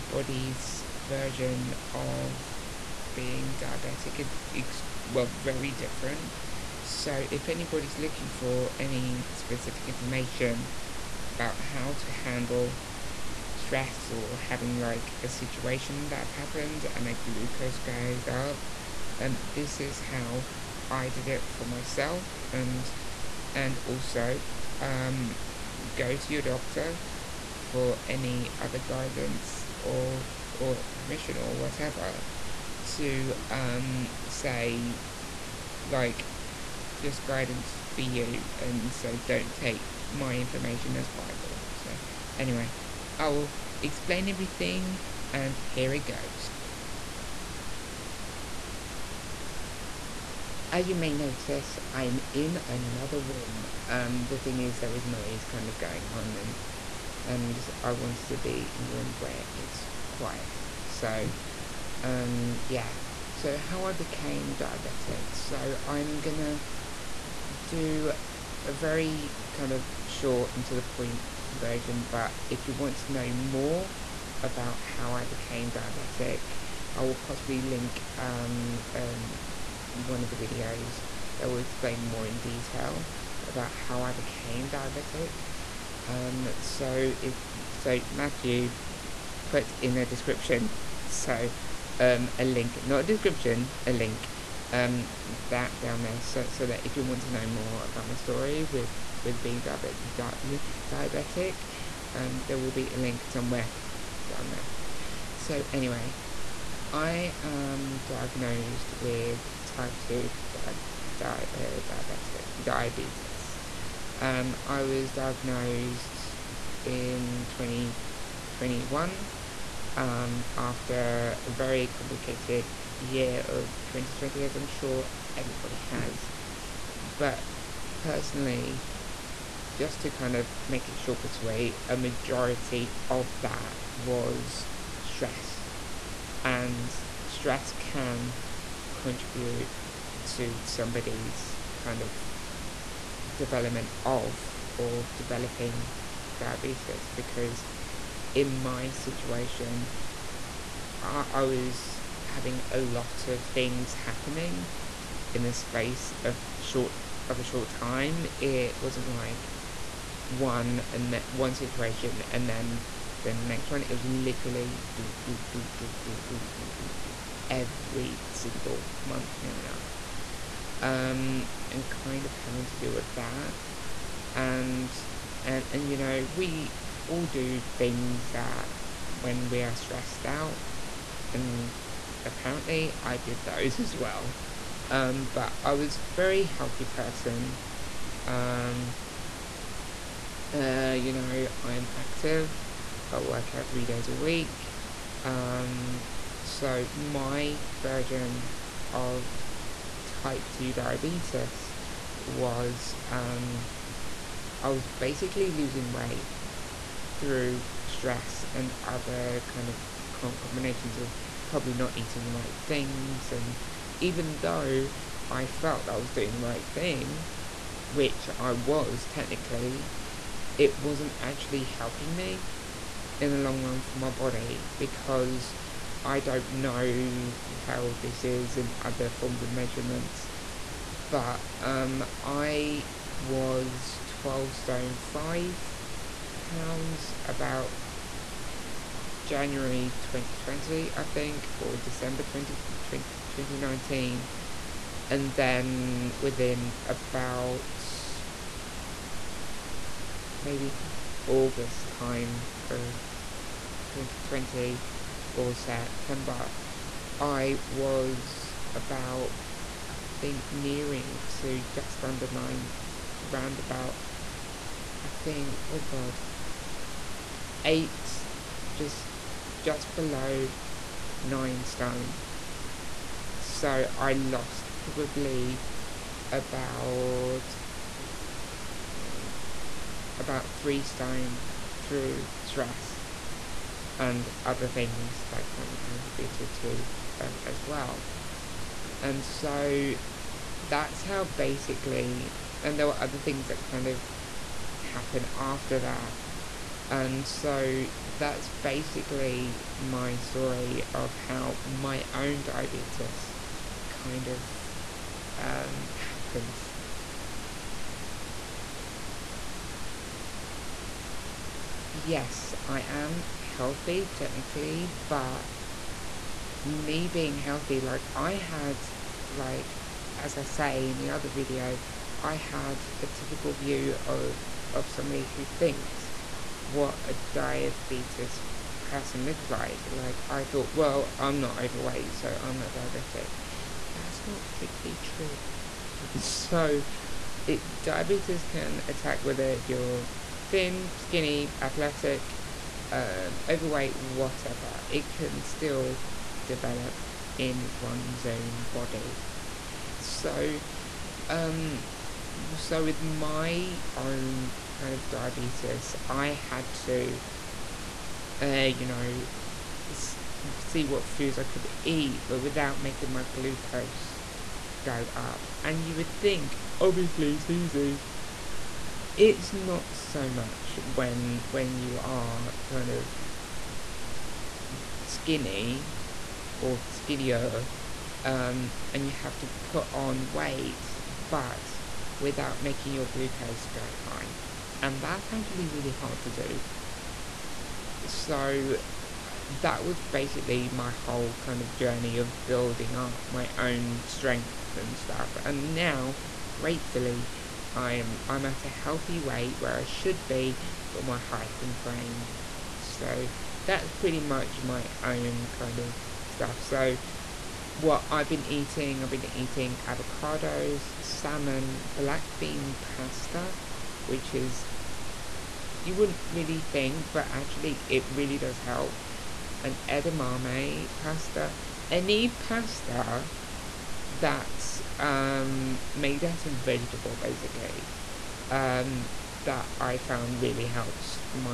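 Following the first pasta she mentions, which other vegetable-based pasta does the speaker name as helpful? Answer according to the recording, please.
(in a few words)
Edamame pasta.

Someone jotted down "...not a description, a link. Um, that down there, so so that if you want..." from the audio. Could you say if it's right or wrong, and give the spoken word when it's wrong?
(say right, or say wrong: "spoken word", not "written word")
right.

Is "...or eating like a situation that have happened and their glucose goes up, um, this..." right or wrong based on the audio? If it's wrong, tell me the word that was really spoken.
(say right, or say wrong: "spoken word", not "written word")
wrong: "having", not "eating".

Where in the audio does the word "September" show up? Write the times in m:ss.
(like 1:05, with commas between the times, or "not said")
4:15.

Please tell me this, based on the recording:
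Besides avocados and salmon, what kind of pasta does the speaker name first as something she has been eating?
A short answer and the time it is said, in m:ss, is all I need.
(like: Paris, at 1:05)
Black bean pasta, at 6:51.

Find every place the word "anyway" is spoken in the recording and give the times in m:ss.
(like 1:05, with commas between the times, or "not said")
0:42, 1:45.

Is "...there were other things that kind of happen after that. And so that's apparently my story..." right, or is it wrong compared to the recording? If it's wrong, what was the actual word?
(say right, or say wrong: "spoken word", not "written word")
wrong: "basically", not "apparently".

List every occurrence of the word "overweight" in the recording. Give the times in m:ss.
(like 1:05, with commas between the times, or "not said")
5:31, 5:43.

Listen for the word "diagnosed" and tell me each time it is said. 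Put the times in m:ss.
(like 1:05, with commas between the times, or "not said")
1:48, 1:55.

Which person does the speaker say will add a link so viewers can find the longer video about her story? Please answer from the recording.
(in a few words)
Matthew.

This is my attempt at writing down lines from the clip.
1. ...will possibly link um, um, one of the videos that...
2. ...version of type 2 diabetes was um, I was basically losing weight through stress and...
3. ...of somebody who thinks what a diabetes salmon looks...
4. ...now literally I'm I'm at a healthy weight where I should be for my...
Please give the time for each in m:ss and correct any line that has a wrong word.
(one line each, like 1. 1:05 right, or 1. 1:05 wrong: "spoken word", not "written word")
1. 1:17 right
2. 3:17 right
3. 5:24 wrong: "person", not "salmon"
4. 6:35 wrong: "gratefully", not "literally".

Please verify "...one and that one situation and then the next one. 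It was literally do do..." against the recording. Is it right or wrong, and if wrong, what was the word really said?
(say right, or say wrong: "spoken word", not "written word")
right.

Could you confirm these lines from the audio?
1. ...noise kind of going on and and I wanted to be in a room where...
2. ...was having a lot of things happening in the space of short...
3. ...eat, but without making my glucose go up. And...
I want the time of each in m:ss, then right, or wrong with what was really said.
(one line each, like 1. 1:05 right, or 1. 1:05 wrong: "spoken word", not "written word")
1. 0:55 right
2. 2:31 right
3. 6:01 right.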